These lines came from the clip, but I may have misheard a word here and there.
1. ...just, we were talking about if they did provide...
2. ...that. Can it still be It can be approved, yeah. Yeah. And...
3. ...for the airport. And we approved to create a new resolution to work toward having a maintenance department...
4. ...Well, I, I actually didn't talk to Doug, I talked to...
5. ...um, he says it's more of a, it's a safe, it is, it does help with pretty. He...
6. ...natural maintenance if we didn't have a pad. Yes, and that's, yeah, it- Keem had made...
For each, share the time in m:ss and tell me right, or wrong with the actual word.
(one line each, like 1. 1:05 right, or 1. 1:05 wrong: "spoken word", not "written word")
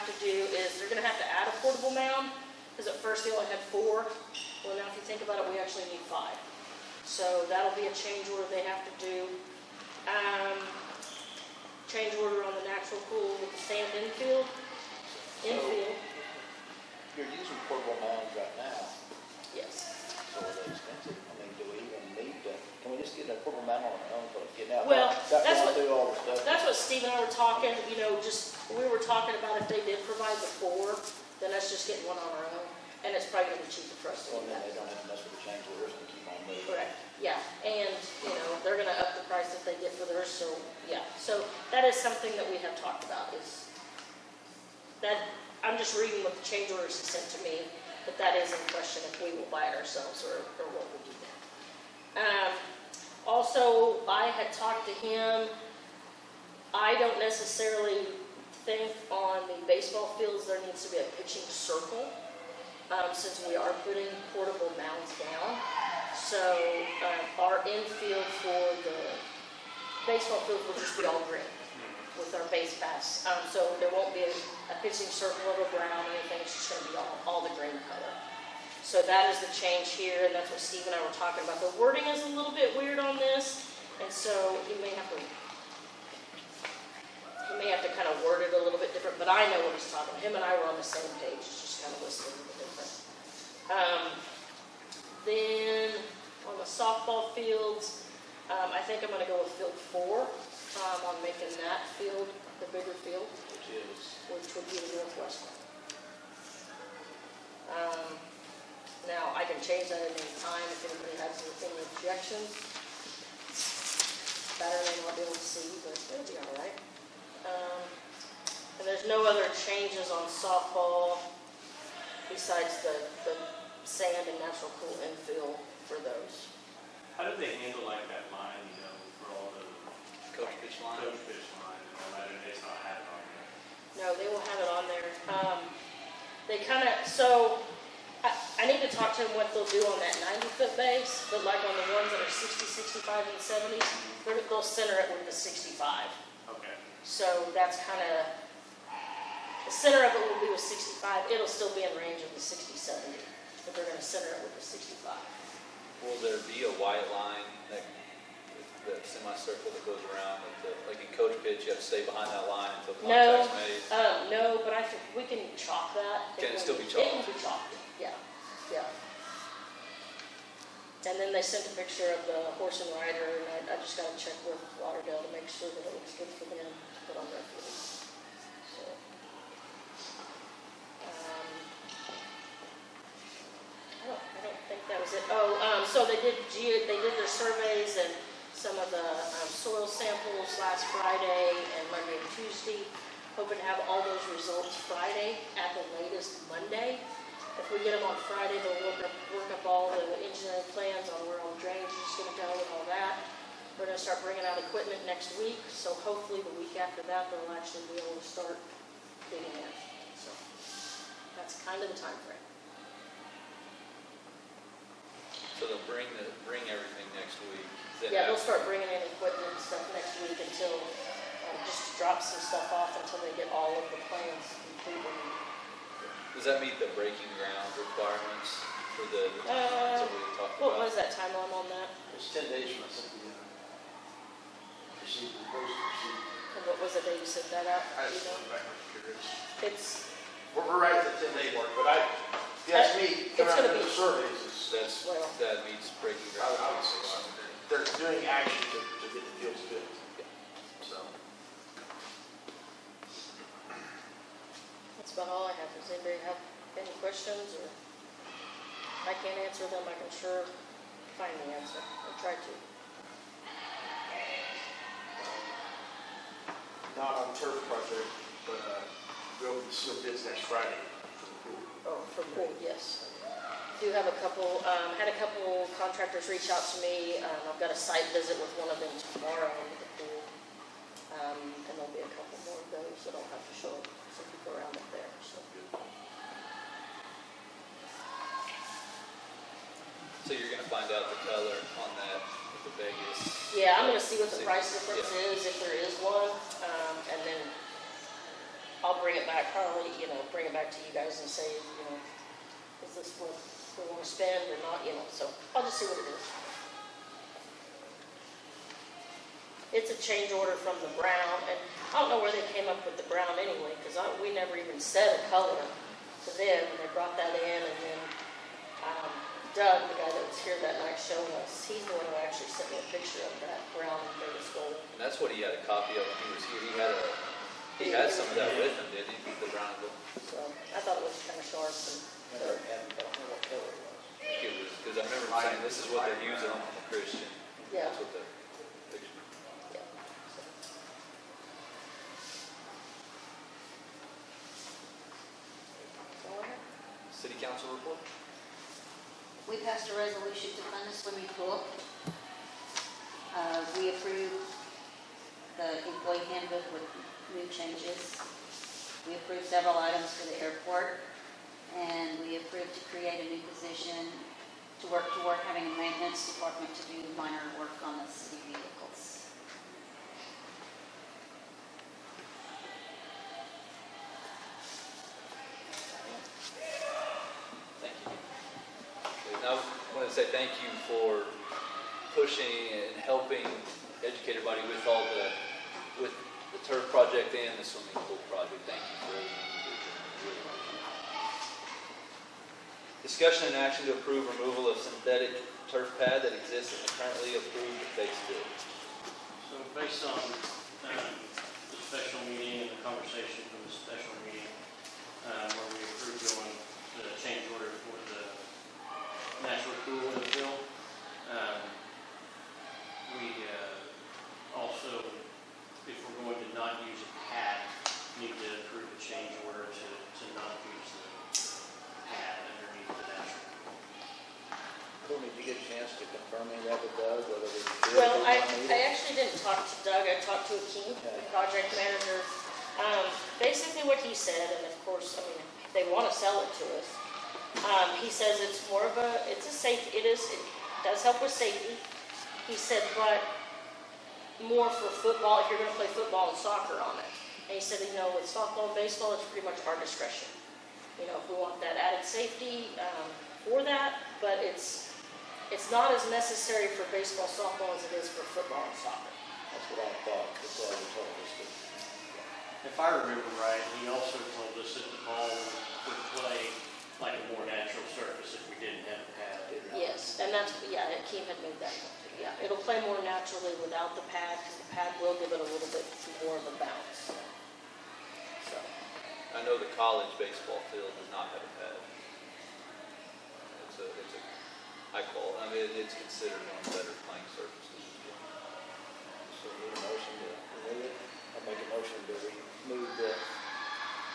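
1. 0:28 right
2. 2:45 wrong: "chalked", not "approved"
3. 6:00 wrong: "position", not "resolution"
4. 7:07 right
5. 7:17 wrong: "safety", not "pretty"
6. 7:47 wrong: "surface", not "maintenance".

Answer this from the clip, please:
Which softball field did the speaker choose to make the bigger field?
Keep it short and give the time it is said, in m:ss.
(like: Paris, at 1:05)
Field 4, at 1:39.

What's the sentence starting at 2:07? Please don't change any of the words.
How do they handle like that line, you know, for all the coach pitch line?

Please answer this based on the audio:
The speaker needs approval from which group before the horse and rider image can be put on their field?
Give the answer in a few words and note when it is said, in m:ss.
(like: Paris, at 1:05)
Lauderdale, at 2:54.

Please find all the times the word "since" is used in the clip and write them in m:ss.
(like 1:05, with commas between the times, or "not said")
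1:03.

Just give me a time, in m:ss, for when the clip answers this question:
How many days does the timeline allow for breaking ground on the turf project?
3:52.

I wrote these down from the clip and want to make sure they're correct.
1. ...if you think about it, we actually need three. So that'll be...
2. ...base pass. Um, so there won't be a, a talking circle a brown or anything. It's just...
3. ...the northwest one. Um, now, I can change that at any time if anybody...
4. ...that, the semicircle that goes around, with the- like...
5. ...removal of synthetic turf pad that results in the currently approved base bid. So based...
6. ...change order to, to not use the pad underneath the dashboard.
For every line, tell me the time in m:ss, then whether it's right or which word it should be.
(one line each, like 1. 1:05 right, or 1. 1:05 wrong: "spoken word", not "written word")
1. 0:04 wrong: "five", not "three"
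2. 1:12 wrong: "pitching", not "talking"
3. 1:44 right
4. 2:37 right
5. 6:34 wrong: "exists", not "results"
6. 6:59 right.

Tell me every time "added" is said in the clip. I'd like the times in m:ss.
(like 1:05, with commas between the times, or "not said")
7:31.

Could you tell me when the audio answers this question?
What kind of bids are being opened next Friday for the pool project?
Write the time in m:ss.
4:29.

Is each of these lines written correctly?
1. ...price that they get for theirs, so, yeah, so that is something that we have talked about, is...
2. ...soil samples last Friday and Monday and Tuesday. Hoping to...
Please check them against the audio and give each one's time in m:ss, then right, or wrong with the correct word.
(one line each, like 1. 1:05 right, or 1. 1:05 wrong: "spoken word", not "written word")
1. 0:39 right
2. 3:09 right.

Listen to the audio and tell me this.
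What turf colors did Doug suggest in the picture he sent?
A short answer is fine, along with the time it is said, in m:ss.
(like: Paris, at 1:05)
Brown and gold, at 5:23.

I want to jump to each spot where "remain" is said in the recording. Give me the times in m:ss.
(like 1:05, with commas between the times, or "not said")
not said.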